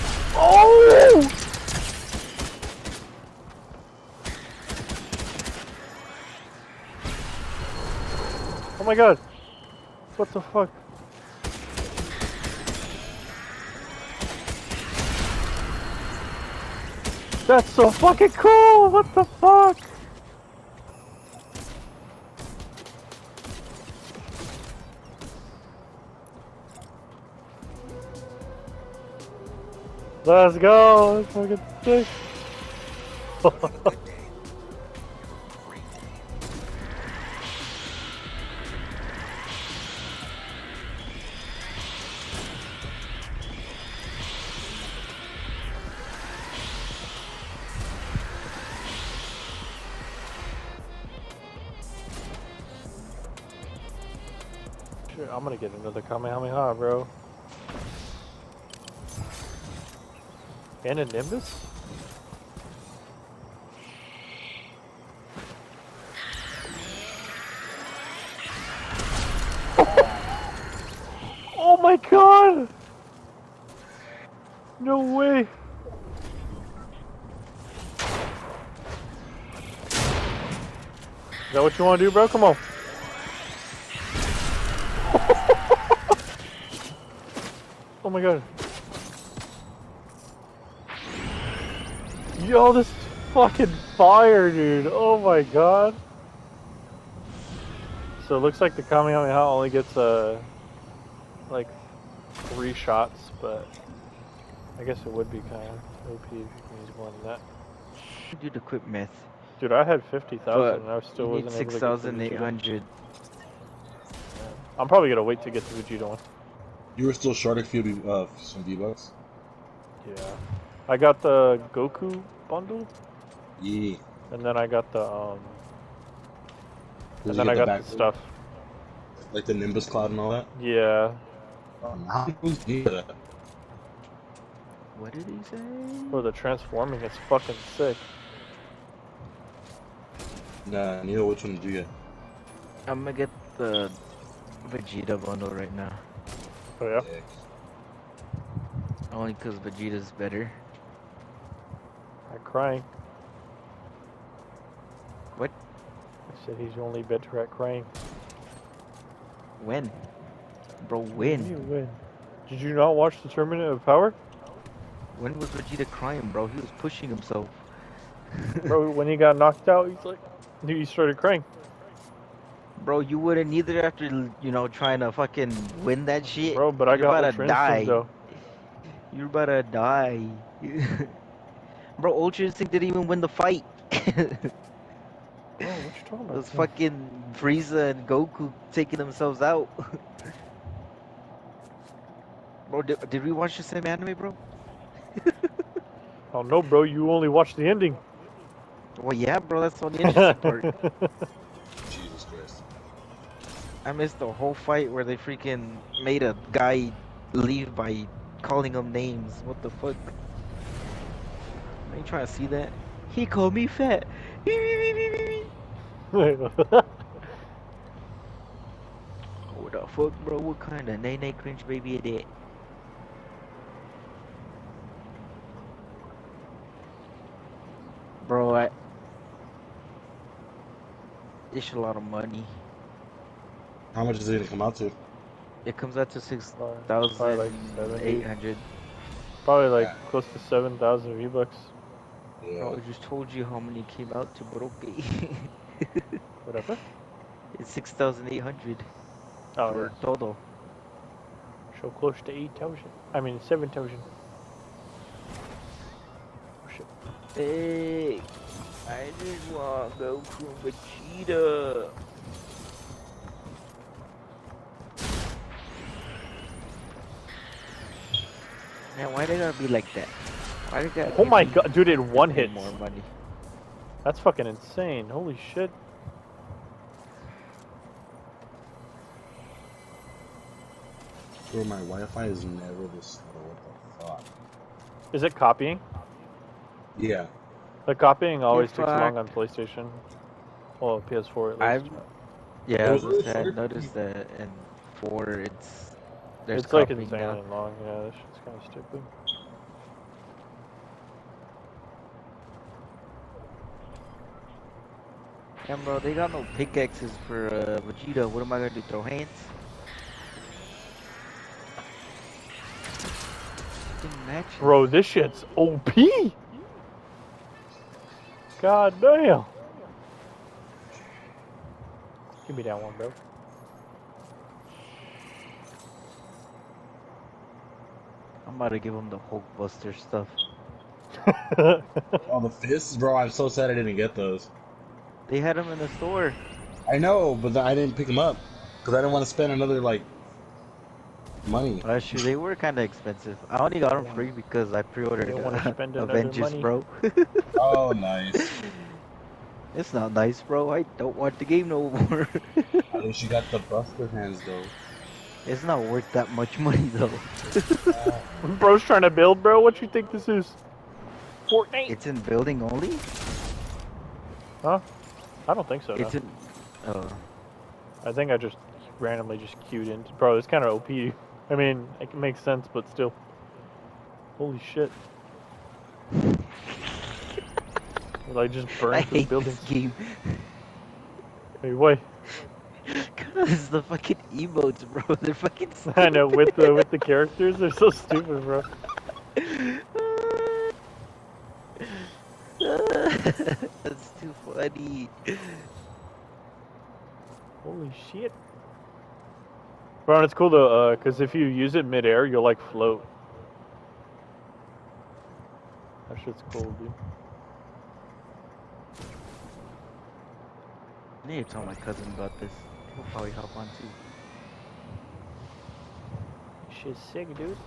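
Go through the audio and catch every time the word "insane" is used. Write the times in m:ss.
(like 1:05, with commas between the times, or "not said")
4:34, 4:56.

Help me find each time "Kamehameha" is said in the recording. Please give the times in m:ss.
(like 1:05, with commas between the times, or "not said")
0:56, 1:38.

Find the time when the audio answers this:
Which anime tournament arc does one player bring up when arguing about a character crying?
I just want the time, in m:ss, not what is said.
2:43.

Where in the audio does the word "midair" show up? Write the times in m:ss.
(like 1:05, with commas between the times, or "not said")
6:41.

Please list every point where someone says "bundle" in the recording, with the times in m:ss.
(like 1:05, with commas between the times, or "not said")
2:02, 2:25.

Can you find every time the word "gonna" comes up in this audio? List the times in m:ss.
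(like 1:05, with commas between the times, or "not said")
0:55, 1:55, 2:23, 3:54, 5:08.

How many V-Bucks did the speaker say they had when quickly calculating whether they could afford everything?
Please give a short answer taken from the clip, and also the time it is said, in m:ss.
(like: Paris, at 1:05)
50,000, at 1:50.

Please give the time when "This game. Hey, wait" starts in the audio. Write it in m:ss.
6:19.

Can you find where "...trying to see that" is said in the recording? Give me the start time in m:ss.
3:32.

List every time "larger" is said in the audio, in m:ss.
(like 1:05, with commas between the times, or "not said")
not said.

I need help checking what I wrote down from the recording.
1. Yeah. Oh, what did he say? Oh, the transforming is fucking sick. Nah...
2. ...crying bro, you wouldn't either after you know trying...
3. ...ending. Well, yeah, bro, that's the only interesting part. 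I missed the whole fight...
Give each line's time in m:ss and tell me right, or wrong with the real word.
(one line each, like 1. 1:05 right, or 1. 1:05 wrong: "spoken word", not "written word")
1. 2:10 right
2. 2:51 right
3. 3:17 right.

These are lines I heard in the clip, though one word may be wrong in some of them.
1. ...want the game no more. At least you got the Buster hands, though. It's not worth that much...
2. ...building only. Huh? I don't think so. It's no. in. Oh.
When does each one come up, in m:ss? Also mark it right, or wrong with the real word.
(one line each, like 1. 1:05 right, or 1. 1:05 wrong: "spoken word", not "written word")
1. 5:51 right
2. 6:02 right.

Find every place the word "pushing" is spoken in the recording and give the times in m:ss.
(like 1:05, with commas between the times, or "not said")
2:46.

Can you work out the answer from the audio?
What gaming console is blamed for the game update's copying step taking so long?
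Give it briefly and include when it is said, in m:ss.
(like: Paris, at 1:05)
PS4, at 4:51.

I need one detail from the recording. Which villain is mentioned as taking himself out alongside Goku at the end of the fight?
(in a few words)
Frieza.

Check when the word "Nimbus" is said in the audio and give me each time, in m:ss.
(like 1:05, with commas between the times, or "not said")
1:01, 2:09.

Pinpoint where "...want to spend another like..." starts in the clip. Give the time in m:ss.
5:39.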